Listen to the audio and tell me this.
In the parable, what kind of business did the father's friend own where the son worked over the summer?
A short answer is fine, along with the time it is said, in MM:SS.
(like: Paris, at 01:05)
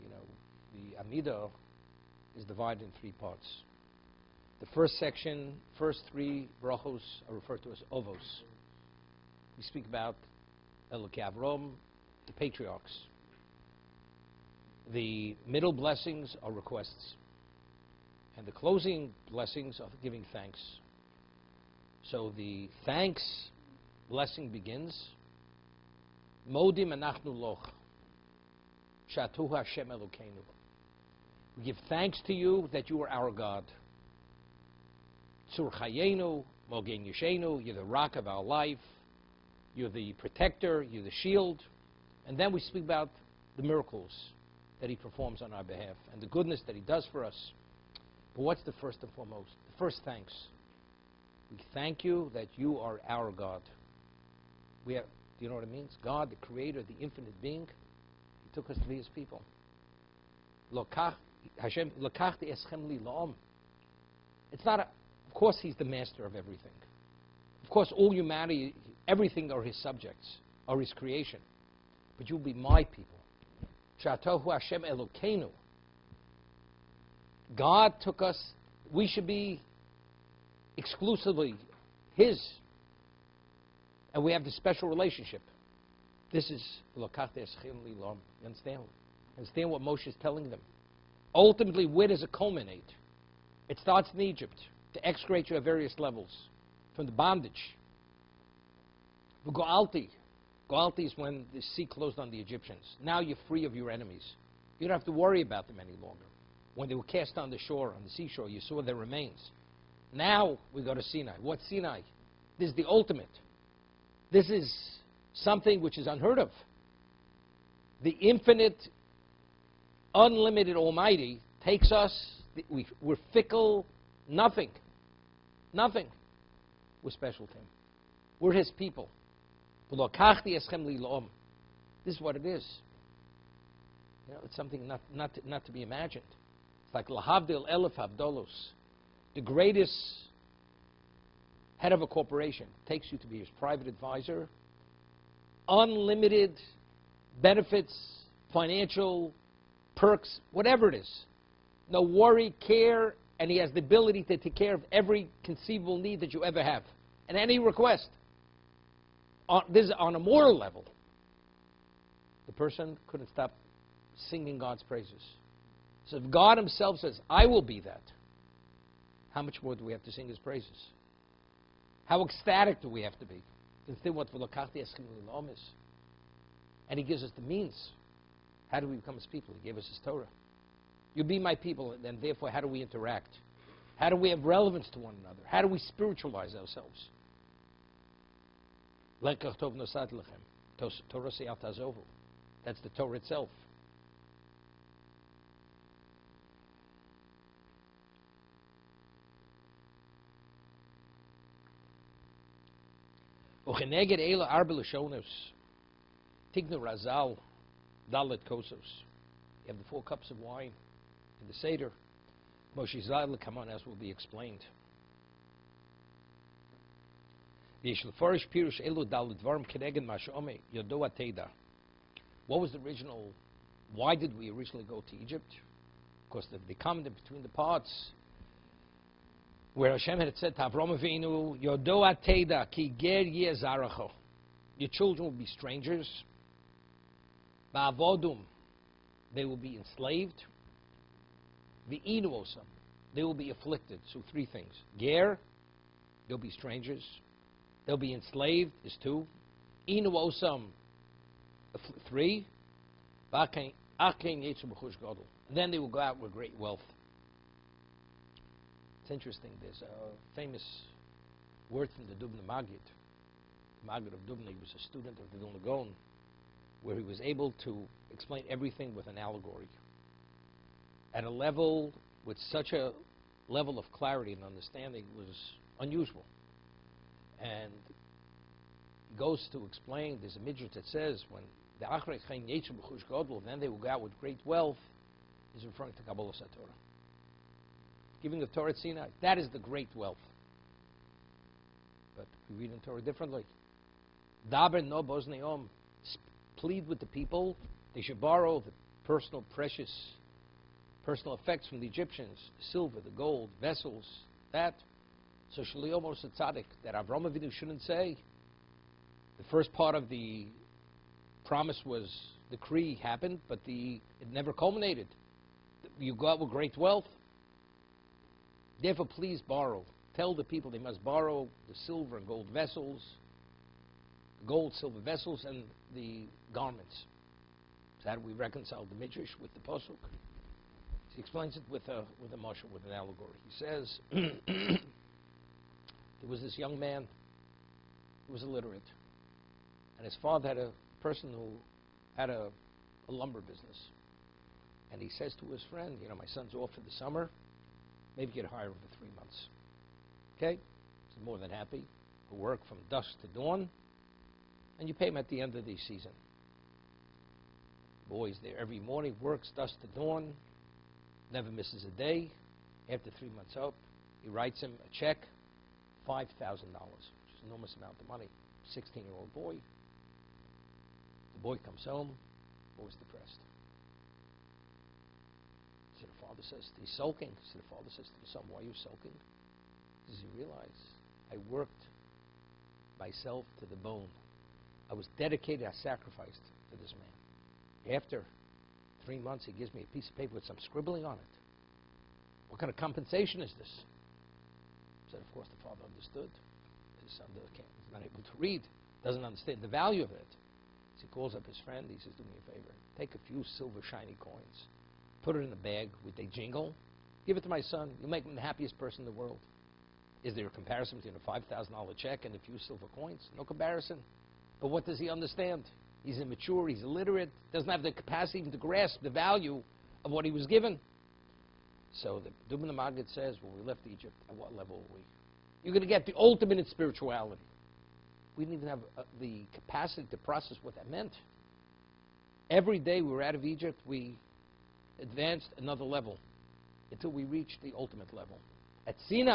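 Lumber business, at 05:43.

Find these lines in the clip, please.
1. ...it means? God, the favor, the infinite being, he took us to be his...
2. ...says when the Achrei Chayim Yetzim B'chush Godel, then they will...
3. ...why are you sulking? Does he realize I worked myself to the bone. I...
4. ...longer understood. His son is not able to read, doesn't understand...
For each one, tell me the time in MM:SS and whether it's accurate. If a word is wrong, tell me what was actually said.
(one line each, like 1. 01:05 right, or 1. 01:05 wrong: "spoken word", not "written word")
1. 00:55 wrong: "creator", not "favor"
2. 04:40 right
3. 06:18 right
4. 06:35 wrong: "father", not "longer".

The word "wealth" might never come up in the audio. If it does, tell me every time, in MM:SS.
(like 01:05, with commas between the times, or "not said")
04:16, 04:44, 04:49, 05:16.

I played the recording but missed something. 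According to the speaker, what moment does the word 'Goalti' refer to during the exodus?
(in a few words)
When the sea closed on the Egyptians.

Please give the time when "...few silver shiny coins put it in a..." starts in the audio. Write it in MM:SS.
06:43.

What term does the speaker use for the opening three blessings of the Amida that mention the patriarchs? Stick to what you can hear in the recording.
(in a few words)
Ovos.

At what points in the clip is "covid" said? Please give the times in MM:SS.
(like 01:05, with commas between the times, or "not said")
not said.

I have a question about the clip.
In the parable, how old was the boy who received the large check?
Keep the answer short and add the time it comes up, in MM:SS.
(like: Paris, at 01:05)
16, at 06:08.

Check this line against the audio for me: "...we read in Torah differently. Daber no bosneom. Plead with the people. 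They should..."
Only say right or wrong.
right.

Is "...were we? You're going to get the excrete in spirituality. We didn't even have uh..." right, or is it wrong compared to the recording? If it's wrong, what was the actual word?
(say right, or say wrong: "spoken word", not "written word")
wrong: "ultimate", not "excrete".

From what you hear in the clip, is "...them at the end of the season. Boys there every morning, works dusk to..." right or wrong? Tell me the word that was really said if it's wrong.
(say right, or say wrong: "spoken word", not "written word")
right.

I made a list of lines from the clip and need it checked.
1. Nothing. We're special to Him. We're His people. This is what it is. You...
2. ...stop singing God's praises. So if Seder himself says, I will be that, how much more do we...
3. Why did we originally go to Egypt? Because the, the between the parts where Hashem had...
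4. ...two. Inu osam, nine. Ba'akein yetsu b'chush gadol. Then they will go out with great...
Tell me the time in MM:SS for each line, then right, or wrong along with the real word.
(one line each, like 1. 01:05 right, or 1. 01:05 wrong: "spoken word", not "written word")
1. 02:05 right
2. 02:43 wrong: "God", not "Seder"
3. 03:43 right
4. 04:09 wrong: "three", not "nine".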